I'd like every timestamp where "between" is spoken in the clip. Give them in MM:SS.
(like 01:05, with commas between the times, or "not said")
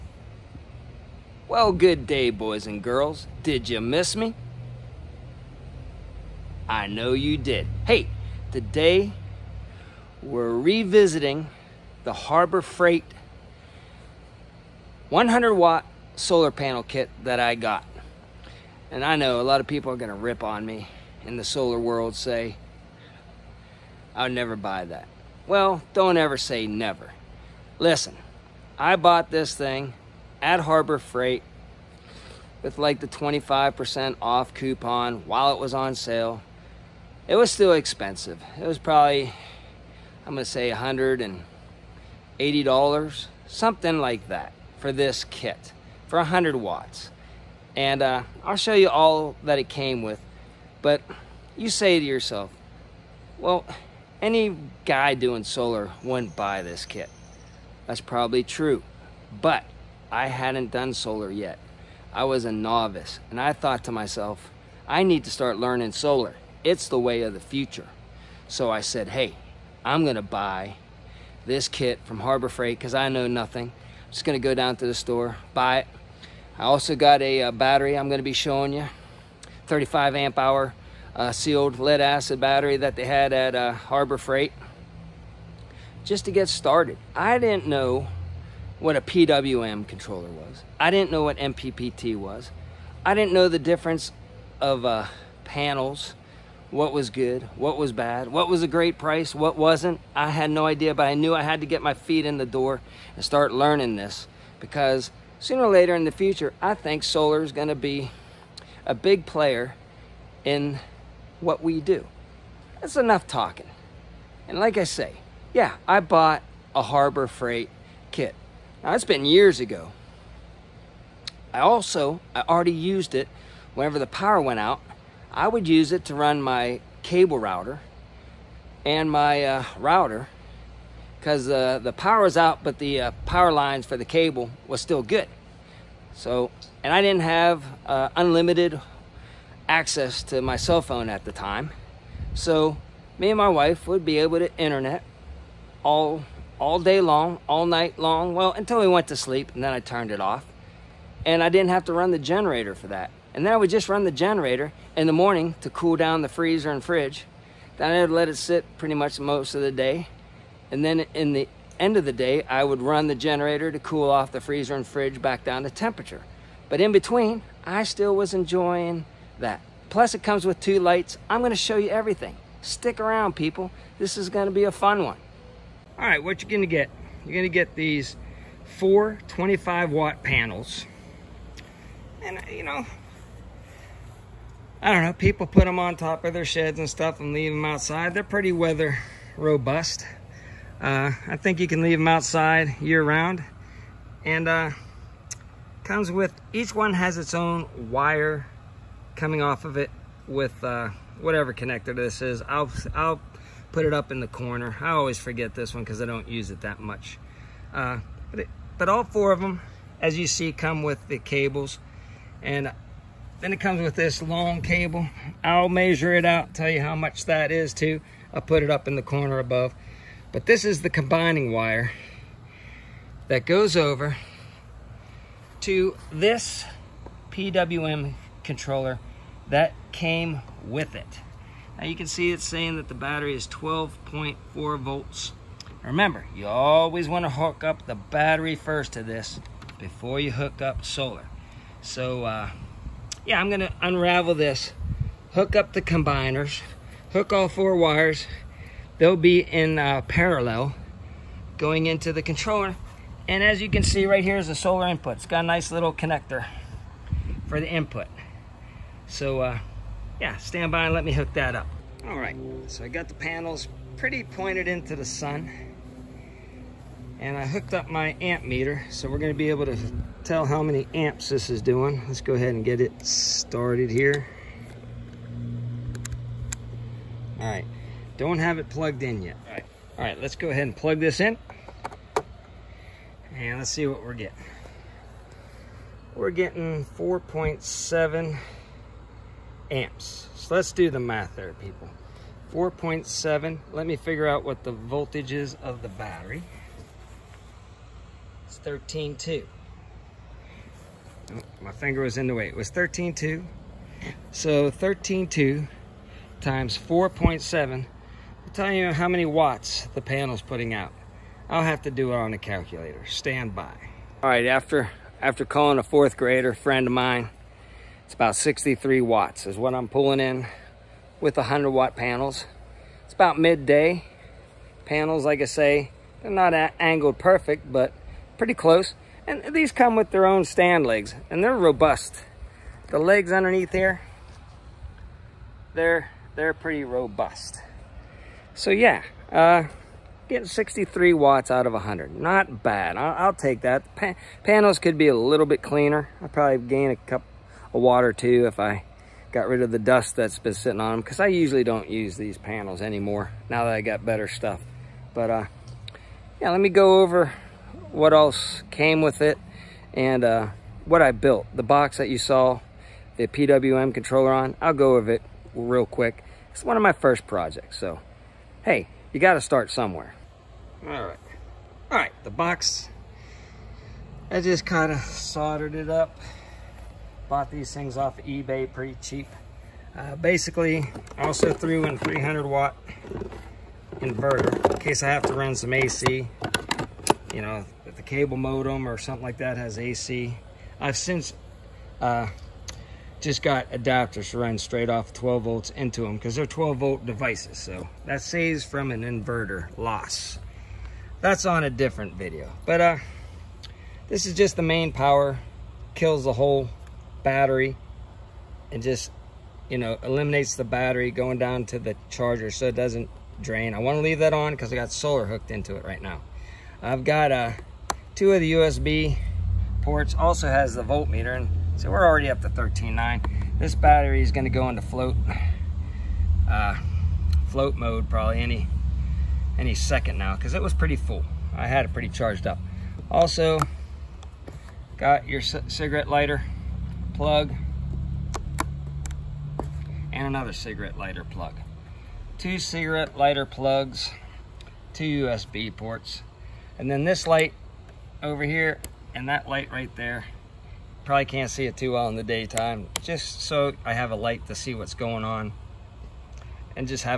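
02:46.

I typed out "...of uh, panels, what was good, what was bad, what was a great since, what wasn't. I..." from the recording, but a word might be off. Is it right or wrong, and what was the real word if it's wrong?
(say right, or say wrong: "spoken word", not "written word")
wrong: "price", not "since".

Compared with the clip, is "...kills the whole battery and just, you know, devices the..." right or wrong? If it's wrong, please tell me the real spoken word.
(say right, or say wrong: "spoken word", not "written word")
wrong: "eliminates", not "devices".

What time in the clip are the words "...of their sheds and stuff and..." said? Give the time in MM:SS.
03:06.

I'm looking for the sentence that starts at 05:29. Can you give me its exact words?
And these come with their own stand legs, and they're robust.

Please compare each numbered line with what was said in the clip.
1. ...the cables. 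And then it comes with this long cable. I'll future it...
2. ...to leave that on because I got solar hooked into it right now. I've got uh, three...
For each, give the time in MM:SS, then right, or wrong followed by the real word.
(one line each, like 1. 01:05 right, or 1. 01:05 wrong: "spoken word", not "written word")
1. 03:31 wrong: "measure", not "future"
2. 06:53 wrong: "two", not "three".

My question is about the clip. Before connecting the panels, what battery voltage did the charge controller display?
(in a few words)
12.4 volts.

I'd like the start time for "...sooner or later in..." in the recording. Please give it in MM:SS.
01:45.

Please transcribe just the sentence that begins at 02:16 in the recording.
So, and I didn't have uh, unlimited access to my cell phone at the time.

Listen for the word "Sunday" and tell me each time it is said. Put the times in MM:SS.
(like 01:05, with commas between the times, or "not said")
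not said.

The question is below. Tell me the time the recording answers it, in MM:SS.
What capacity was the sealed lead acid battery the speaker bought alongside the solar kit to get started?
01:19.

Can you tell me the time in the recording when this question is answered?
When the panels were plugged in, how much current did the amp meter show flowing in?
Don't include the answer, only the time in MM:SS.
04:46.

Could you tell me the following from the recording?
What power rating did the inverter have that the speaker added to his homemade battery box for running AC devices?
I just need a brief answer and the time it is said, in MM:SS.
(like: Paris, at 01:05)
300 watt, at 06:21.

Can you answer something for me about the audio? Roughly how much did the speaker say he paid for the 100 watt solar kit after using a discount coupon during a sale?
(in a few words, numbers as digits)
$180.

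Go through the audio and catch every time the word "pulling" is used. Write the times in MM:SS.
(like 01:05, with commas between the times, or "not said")
05:19.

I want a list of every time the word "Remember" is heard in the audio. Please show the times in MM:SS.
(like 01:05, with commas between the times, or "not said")
03:55.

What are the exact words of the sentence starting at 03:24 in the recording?
I always forget this one because I don't use it that much.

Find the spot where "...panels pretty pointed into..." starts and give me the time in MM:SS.
04:23.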